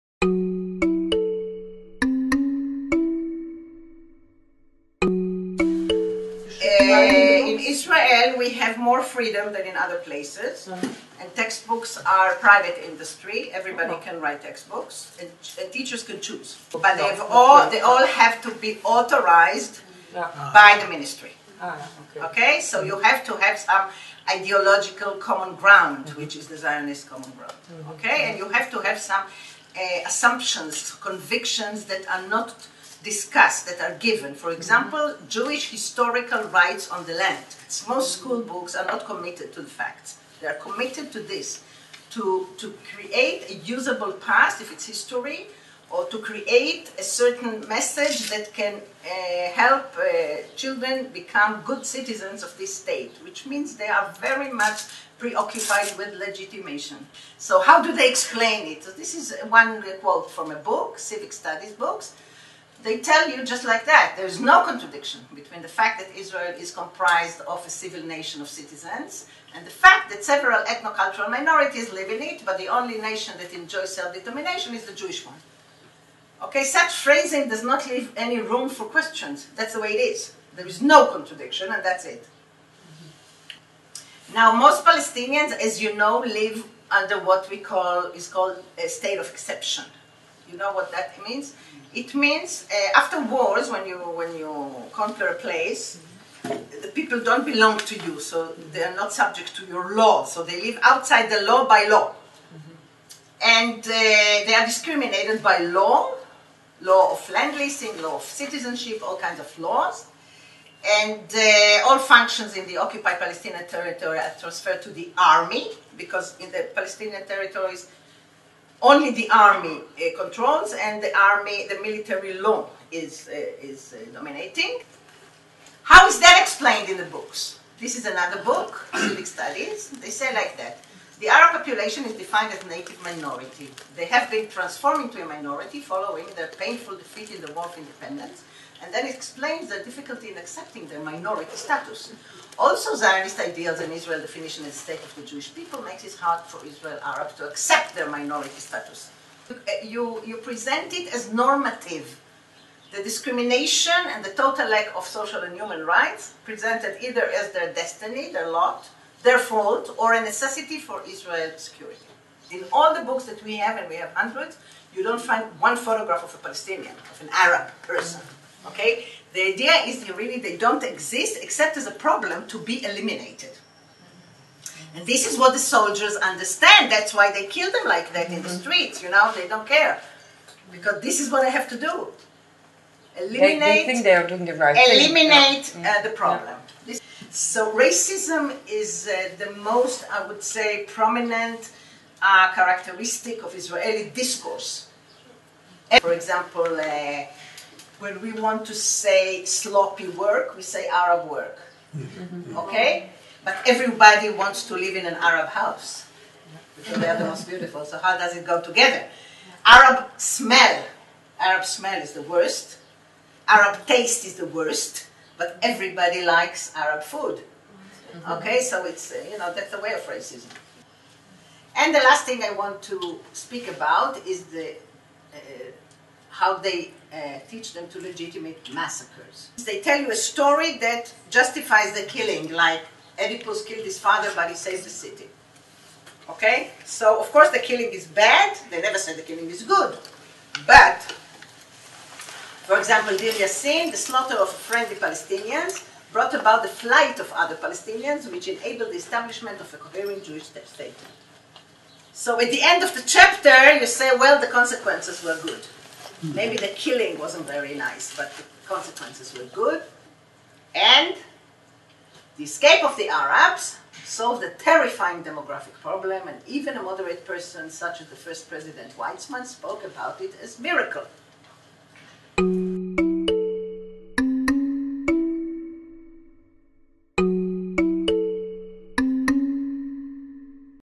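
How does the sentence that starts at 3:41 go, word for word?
And the last thing I want to speak about is the, uh, how they uh, teach them to legitimate massacres.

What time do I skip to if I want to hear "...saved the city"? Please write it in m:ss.
3:54.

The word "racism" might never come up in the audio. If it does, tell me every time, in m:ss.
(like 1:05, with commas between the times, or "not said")
3:07, 3:40.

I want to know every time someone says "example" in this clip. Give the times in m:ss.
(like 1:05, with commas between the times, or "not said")
0:34, 3:16, 4:02.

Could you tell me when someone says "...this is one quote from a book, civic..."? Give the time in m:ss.
0:59.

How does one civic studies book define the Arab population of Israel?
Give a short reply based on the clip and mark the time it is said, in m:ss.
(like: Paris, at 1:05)
native minority, at 2:12.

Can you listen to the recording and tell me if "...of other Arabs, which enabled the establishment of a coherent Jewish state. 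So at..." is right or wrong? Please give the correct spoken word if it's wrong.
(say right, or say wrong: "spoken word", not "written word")
wrong: "Palestinians", not "Arabs".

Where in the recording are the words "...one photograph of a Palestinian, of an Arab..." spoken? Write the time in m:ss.
2:45.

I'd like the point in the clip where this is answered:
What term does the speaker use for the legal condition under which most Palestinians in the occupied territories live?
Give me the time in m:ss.
1:28.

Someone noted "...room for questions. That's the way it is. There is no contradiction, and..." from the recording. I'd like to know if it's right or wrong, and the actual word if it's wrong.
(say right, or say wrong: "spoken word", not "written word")
right.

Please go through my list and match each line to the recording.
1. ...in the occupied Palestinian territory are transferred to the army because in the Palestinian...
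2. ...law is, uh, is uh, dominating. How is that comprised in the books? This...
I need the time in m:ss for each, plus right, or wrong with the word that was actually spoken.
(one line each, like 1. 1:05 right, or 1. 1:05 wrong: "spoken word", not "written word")
1. 1:52 right
2. 2:02 wrong: "explained", not "comprised".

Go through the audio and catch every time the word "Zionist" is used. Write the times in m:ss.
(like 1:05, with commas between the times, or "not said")
0:26, 2:22.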